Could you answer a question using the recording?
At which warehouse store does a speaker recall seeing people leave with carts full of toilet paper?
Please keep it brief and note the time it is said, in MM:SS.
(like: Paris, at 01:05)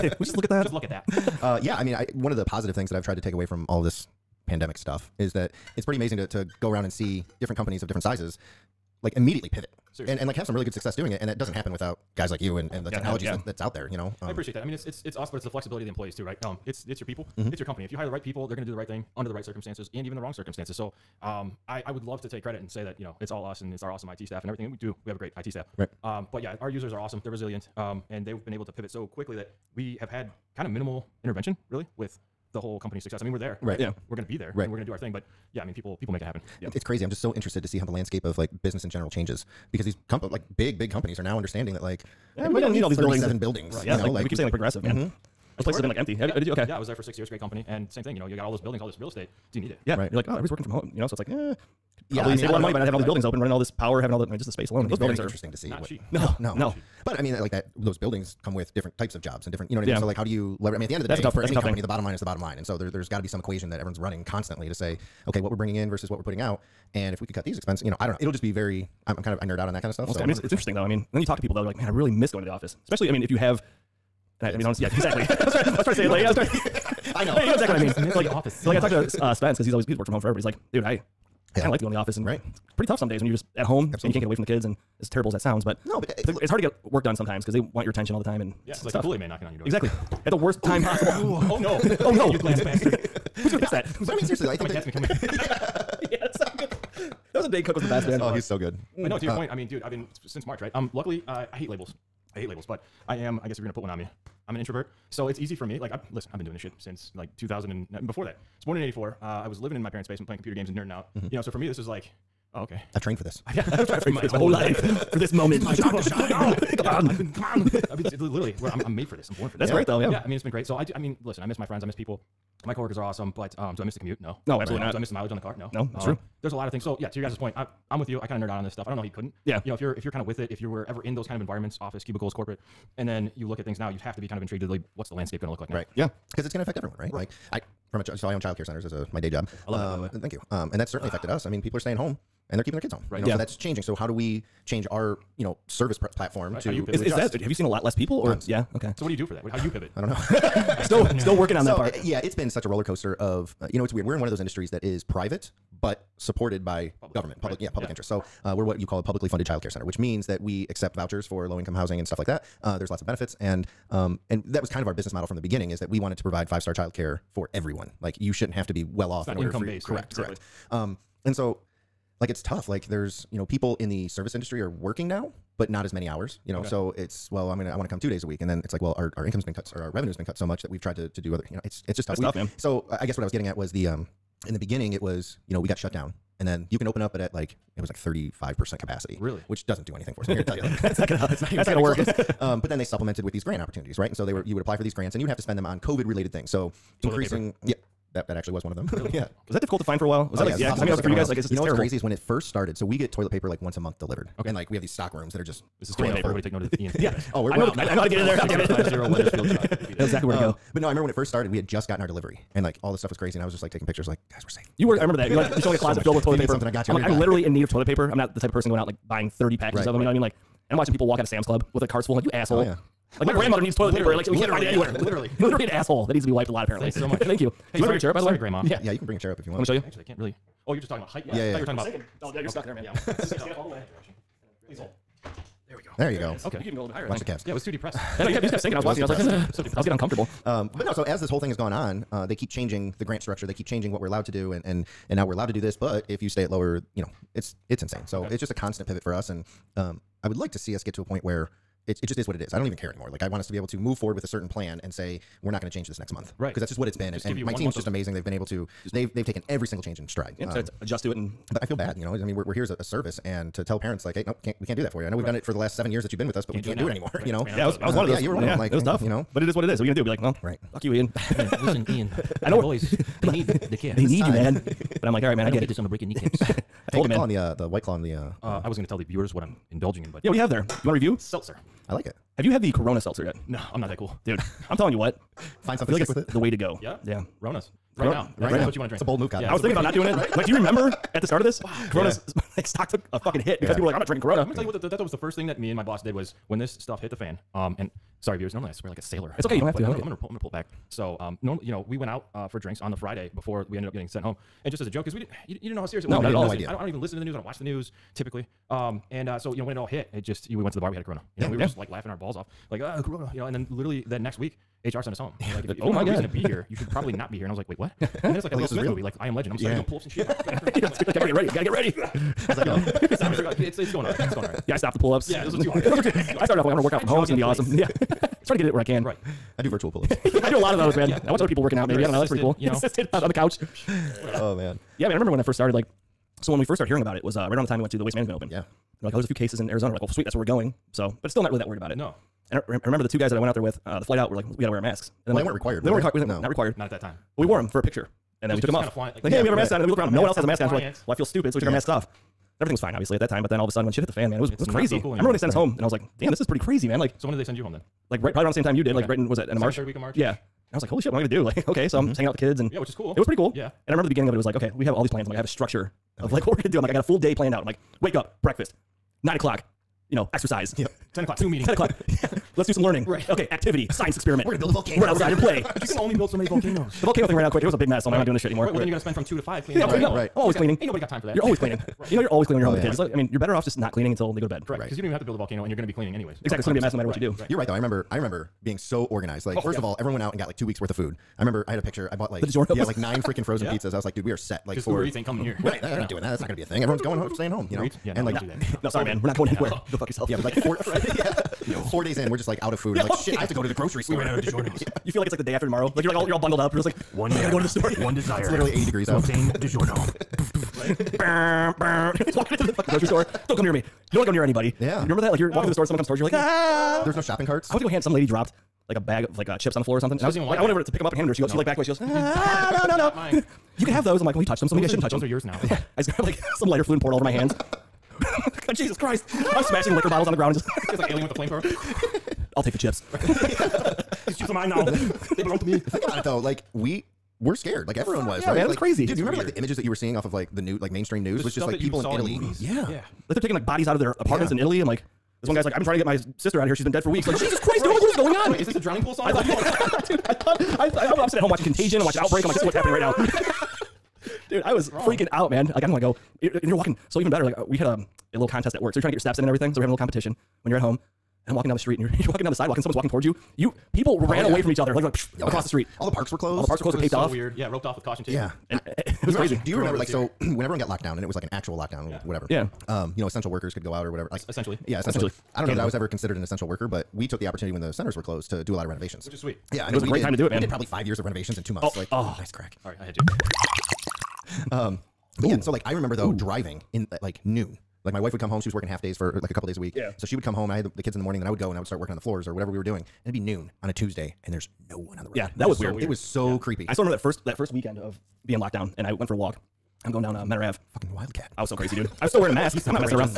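Sam's Club, at 03:41.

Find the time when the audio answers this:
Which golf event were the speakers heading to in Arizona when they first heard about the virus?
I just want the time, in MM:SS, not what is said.
05:38.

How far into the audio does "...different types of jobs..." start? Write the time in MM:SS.
00:58.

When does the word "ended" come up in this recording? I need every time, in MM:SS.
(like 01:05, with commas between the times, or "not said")
05:03.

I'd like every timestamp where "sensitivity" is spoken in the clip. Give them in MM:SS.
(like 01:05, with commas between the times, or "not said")
not said.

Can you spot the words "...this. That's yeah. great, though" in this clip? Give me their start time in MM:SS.
01:59.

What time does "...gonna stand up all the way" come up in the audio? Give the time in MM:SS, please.
03:53.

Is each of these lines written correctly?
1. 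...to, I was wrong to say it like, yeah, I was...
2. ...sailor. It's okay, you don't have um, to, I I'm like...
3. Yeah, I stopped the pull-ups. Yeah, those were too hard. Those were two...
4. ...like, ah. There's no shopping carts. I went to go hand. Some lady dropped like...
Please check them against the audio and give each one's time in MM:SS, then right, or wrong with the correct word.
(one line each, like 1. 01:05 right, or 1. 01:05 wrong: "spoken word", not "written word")
1. 01:15 wrong: "trying", not "wrong"
2. 04:59 right
3. 05:24 right
4. 06:56 right.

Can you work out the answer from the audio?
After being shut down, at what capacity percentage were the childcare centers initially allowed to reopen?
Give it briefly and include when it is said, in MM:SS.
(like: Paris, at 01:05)
35%, at 03:07.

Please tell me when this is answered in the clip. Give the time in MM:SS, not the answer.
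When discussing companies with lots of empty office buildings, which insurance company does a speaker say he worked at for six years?
00:44.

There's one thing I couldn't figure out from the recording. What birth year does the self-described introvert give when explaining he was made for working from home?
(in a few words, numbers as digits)
1984.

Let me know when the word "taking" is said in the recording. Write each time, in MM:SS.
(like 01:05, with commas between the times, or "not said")
03:33, 07:23.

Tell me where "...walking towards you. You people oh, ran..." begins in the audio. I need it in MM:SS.
07:42.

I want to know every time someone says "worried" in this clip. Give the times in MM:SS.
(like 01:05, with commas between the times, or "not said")
05:41.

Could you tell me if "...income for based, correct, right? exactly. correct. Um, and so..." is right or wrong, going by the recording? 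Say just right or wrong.
right.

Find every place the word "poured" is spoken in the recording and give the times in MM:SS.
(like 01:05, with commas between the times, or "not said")
07:07.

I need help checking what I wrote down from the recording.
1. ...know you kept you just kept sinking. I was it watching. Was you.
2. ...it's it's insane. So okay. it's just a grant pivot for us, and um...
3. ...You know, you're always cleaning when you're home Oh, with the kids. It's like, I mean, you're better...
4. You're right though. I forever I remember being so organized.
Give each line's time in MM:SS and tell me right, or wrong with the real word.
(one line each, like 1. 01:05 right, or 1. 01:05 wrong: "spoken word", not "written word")
1. 03:58 right
2. 04:07 wrong: "constant", not "grant"
3. 06:22 right
4. 06:27 wrong: "remember", not "forever".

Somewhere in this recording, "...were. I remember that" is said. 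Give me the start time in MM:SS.
03:34.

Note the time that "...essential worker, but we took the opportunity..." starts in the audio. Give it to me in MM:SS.
07:56.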